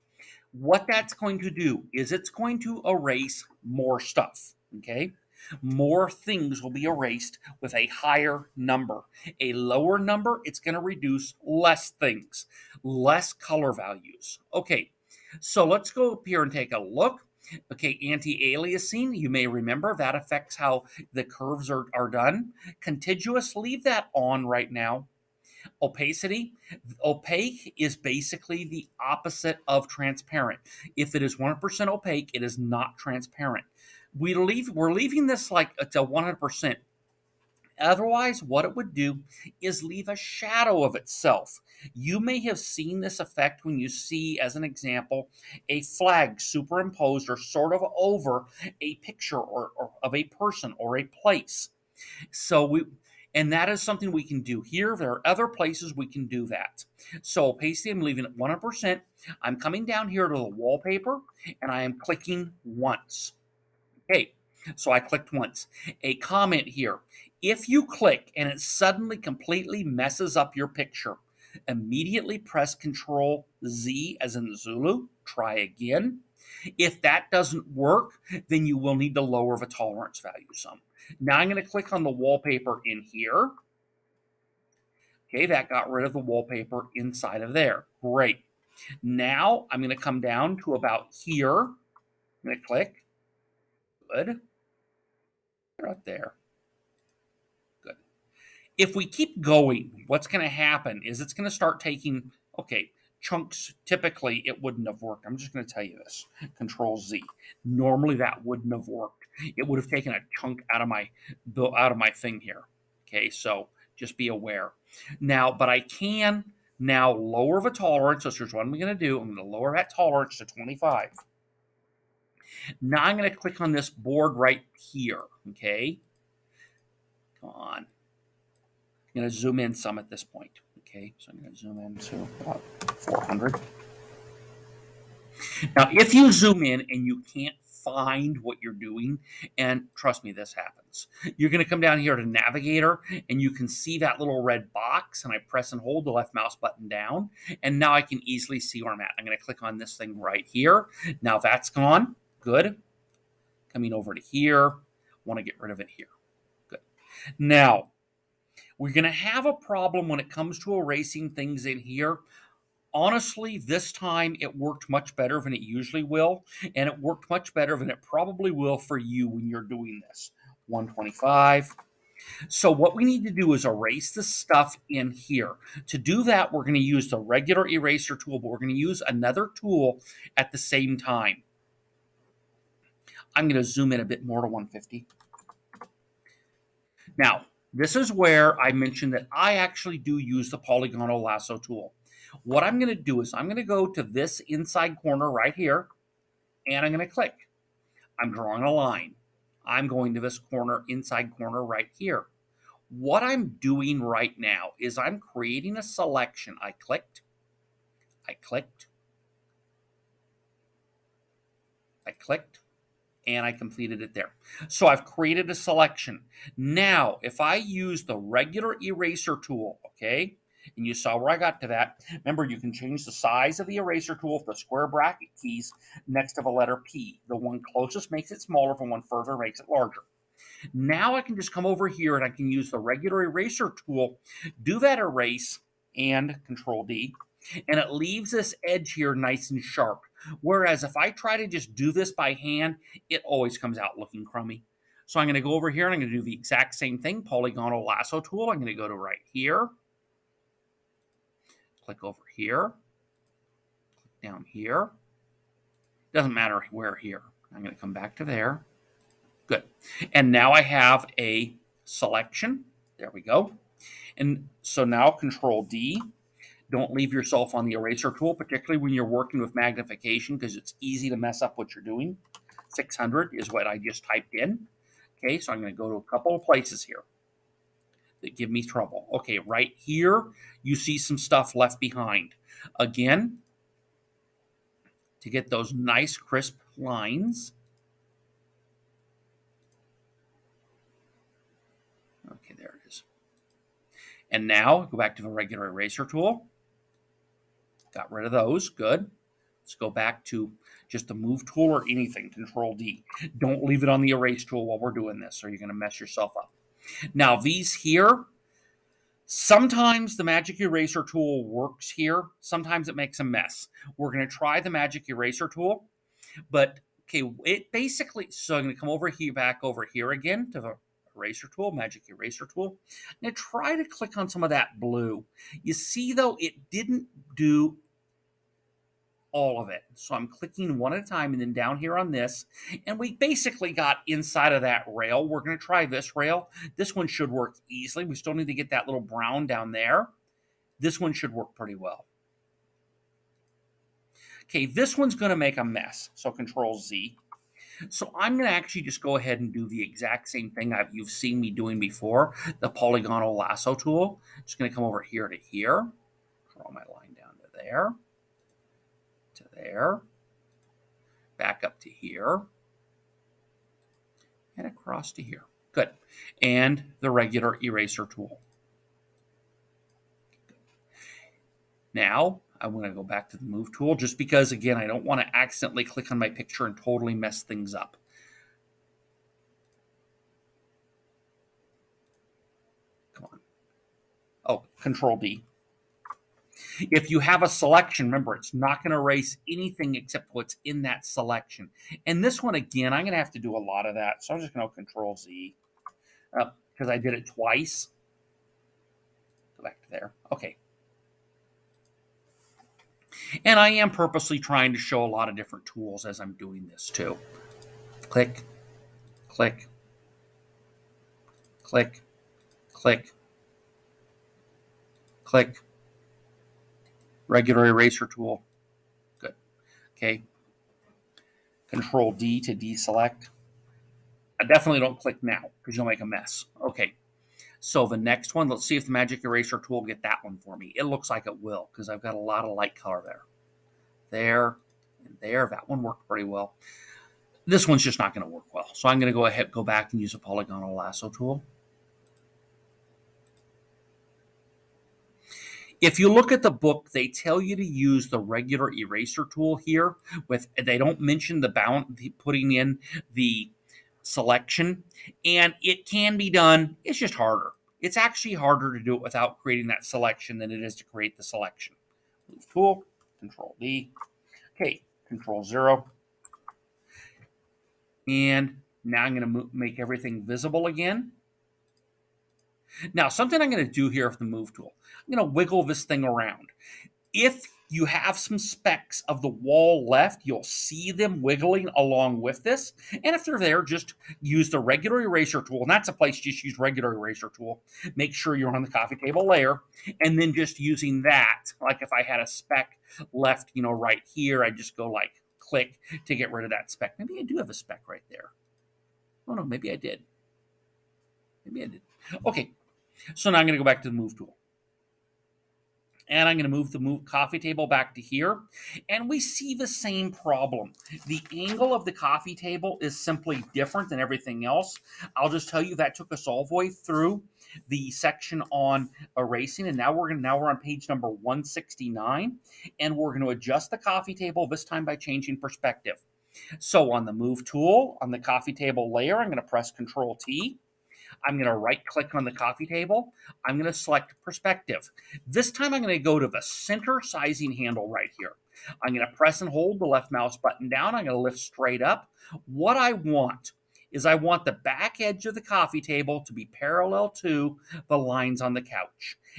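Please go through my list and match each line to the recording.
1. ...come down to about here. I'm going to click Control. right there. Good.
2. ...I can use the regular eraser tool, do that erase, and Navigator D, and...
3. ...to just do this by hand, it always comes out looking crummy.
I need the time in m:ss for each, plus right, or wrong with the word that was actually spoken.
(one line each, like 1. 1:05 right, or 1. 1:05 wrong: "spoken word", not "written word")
1. 1:30 wrong: "Good", not "Control"
2. 3:52 wrong: "Control", not "Navigator"
3. 4:01 right.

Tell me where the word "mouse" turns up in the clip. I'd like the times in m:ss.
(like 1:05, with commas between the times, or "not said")
2:26, 9:00.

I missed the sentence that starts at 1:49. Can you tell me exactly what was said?
It would have taken a chunk out of my out of my thing here.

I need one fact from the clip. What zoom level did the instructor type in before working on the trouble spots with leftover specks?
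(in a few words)
600.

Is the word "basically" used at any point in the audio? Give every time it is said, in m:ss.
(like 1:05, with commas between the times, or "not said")
0:27, 0:57, 5:17, 5:33.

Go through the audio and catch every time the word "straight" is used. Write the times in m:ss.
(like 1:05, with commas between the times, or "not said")
9:01.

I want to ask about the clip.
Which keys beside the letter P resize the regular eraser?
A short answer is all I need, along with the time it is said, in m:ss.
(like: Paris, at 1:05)
square bracket keys, at 3:44.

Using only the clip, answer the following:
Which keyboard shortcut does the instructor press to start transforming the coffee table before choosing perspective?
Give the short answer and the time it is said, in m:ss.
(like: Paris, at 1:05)
Control T, at 8:49.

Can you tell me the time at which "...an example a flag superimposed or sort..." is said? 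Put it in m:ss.
0:44.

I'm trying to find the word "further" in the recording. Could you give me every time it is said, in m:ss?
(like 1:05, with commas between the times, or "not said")
3:49.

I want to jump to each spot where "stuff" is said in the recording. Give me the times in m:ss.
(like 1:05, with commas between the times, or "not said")
0:03, 2:54, 4:41.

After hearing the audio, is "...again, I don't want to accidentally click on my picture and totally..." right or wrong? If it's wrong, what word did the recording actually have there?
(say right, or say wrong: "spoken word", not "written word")
right.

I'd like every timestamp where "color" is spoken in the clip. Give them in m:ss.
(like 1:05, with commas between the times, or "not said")
0:13, 7:12.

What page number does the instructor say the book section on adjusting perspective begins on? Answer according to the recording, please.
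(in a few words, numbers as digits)
169.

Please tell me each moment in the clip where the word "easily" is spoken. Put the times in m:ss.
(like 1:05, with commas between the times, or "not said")
2:28, 5:37.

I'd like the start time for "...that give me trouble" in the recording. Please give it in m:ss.
4:38.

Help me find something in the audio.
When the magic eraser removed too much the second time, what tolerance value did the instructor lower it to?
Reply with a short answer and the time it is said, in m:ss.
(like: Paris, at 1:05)
25, at 2:00.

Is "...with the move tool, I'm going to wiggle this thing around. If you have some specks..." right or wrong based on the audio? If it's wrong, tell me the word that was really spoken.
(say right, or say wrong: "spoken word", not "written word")
right.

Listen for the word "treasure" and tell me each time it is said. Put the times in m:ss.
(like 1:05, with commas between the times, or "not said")
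not said.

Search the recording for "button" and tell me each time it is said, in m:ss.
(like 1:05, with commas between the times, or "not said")
2:26, 9:00.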